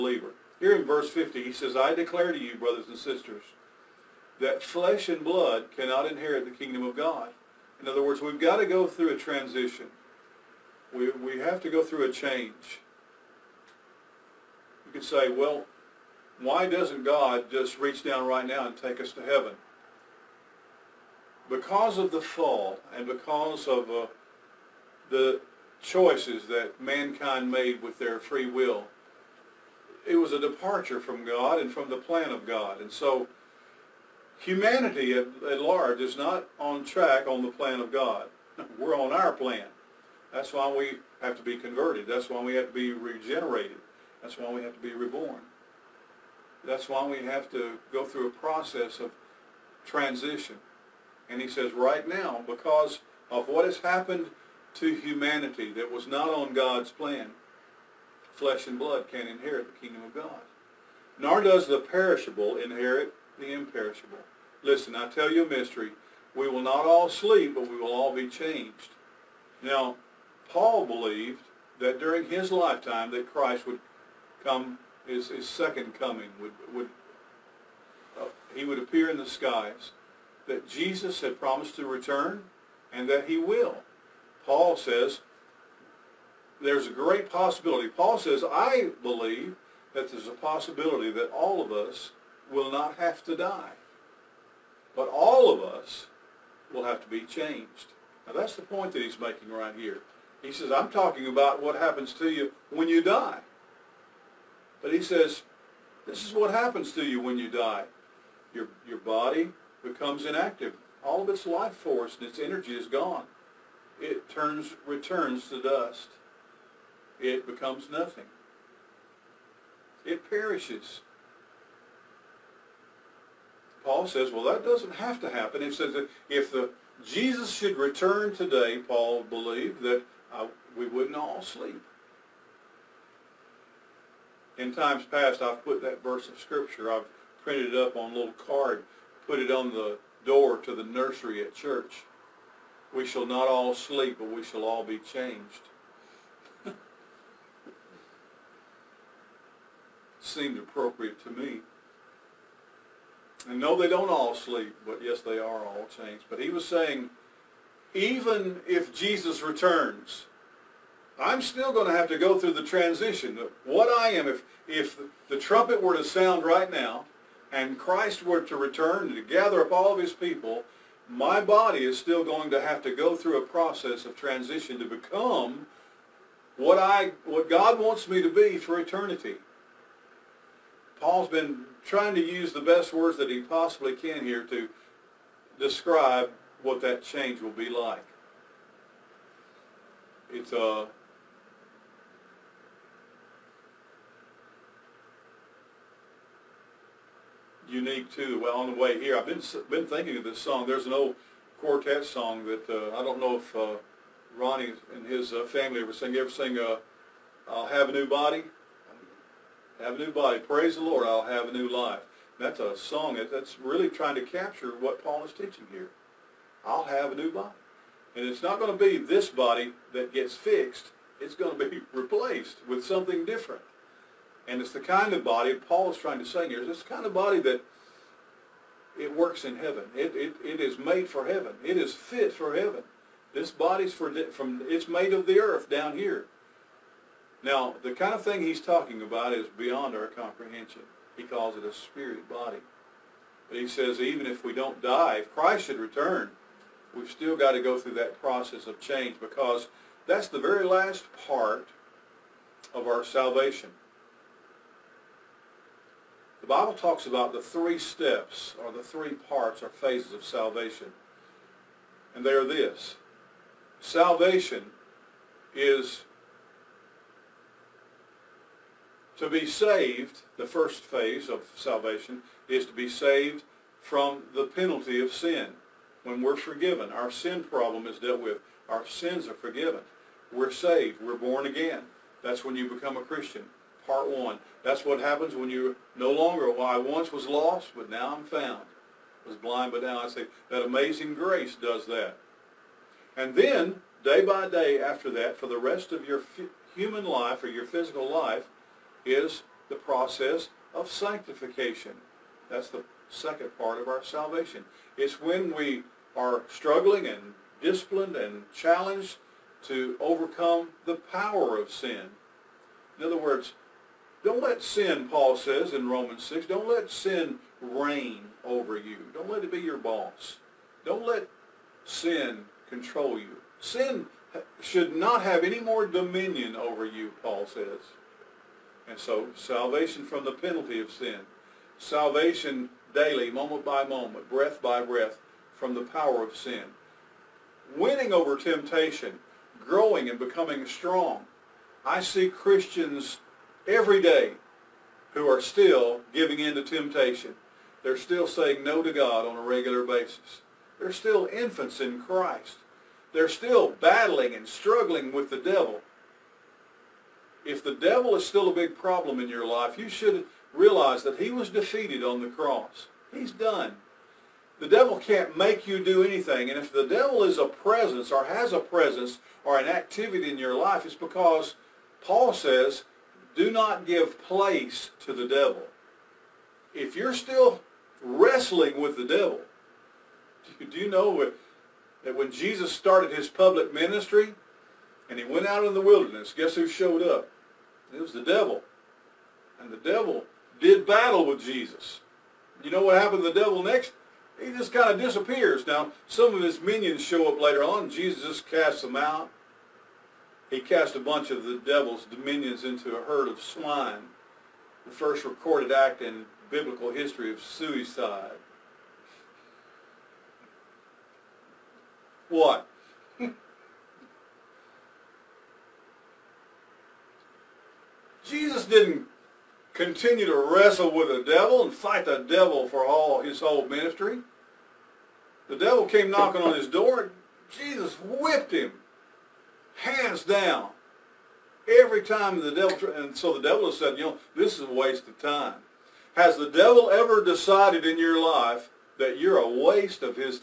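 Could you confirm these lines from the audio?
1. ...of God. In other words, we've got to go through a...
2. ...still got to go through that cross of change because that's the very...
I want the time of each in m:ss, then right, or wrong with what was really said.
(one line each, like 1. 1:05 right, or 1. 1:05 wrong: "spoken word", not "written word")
1. 0:06 right
2. 4:07 wrong: "process", not "cross".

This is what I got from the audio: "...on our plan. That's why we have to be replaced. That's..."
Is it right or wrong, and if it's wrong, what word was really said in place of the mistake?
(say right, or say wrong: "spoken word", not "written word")
wrong: "converted", not "replaced".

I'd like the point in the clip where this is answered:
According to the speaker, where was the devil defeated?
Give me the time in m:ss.
6:02.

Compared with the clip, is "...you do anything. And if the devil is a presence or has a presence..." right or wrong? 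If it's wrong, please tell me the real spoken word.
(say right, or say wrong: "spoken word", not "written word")
right.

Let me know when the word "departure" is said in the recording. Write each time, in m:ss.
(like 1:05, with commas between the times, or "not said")
0:30.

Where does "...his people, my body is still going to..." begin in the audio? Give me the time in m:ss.
2:49.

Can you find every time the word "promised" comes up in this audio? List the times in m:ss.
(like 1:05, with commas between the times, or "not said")
1:21.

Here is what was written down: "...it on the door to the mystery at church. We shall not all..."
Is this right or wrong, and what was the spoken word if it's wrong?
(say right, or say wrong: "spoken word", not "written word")
wrong: "nursery", not "mystery".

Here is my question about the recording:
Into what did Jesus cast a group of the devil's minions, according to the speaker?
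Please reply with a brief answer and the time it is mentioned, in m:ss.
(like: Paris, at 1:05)
A herd of swine, at 6:42.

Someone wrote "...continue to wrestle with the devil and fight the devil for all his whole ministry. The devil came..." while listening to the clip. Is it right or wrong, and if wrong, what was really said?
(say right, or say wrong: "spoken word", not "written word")
right.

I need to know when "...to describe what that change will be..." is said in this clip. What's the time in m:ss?
3:04.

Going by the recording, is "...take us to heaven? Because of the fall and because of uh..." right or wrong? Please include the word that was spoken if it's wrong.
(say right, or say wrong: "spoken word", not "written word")
right.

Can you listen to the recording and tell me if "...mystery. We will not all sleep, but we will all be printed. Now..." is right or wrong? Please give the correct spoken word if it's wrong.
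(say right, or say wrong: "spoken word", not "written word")
wrong: "changed", not "printed".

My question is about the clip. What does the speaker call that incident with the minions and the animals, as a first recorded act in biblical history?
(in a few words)
Suicide.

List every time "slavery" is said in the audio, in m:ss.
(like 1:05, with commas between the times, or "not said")
not said.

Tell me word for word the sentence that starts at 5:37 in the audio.
Winning over temptation, growing and becoming strong.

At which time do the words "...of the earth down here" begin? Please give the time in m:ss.
3:55.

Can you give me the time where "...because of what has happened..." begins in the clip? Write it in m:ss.
0:52.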